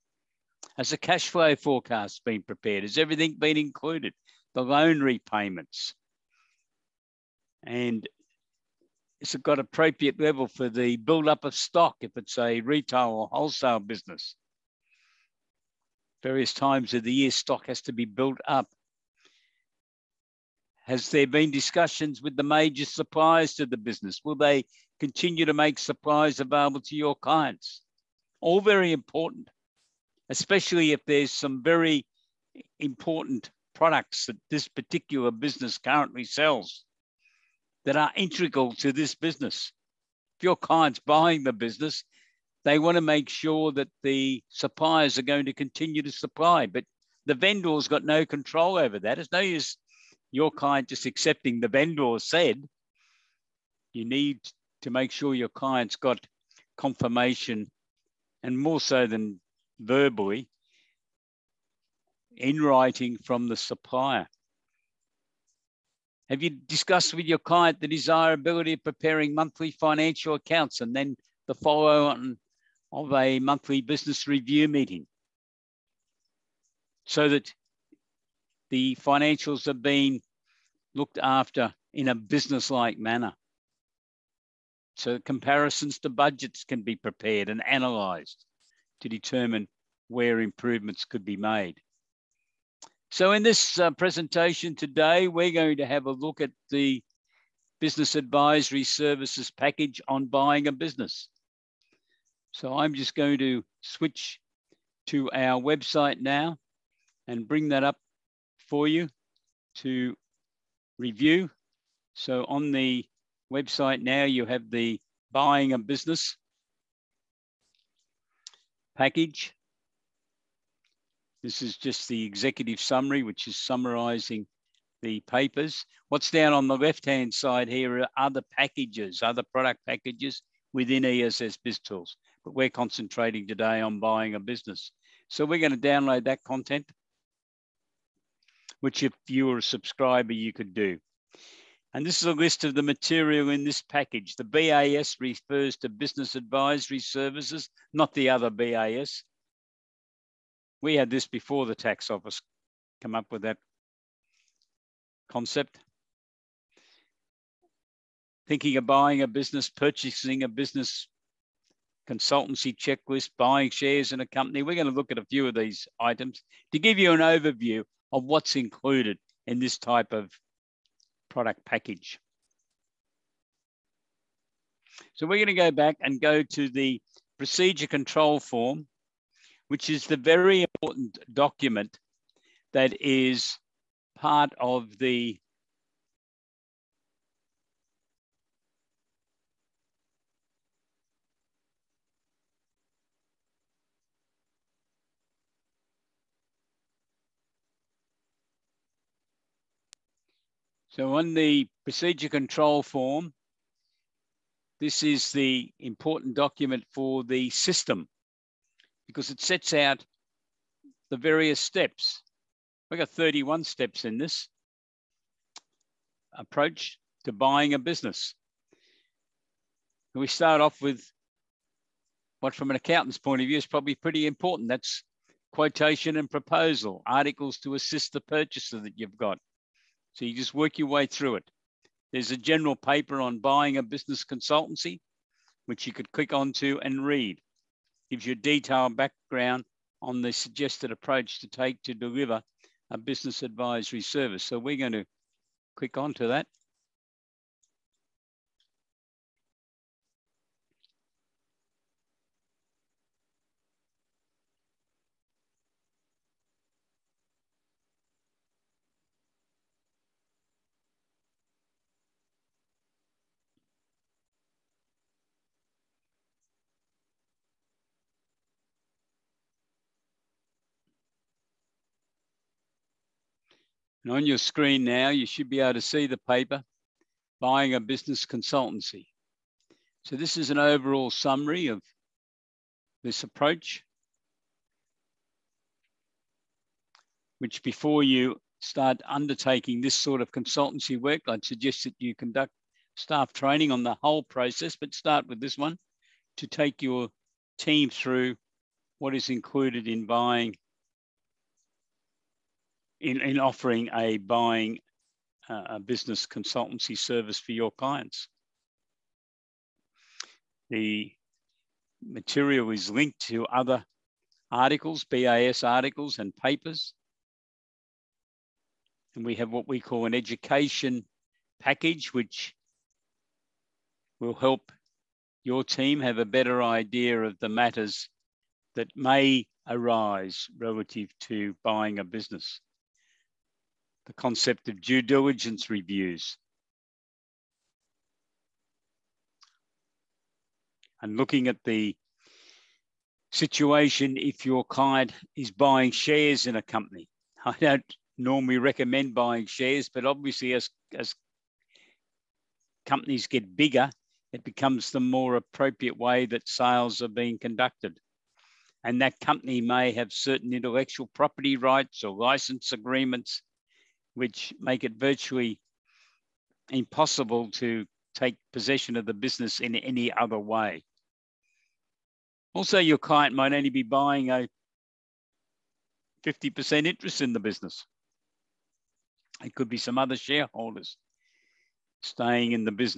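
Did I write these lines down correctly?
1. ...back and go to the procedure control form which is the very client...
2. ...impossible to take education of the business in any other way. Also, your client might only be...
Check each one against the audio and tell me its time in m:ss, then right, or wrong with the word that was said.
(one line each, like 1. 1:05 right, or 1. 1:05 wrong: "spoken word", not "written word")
1. 2:55 wrong: "important", not "client"
2. 6:06 wrong: "possession", not "education".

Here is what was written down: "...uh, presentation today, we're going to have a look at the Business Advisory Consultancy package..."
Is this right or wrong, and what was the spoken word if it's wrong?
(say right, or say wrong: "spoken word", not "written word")
wrong: "Services", not "Consultancy".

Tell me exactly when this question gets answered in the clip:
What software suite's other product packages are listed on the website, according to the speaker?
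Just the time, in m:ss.
2:11.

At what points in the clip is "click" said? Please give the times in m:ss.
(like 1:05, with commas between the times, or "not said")
3:56, 4:05.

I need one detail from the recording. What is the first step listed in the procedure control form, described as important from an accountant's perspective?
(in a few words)
Quotation and proposal.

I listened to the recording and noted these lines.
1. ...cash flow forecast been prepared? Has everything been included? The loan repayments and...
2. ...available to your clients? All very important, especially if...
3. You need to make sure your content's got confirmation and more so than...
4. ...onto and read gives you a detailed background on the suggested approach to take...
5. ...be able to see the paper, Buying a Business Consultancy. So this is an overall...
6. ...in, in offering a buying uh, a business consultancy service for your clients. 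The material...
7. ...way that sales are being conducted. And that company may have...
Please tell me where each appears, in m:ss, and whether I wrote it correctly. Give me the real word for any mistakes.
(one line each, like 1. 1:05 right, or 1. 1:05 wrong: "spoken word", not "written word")
1. 0:00 right
2. 0:26 right
3. 0:53 wrong: "client", not "content"
4. 3:56 right
5. 4:35 right
6. 5:03 right
7. 5:55 right.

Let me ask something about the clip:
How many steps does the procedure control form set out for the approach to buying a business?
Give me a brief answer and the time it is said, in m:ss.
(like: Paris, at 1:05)
31, at 3:33.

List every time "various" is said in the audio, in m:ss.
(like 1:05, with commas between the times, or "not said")
0:16, 3:31.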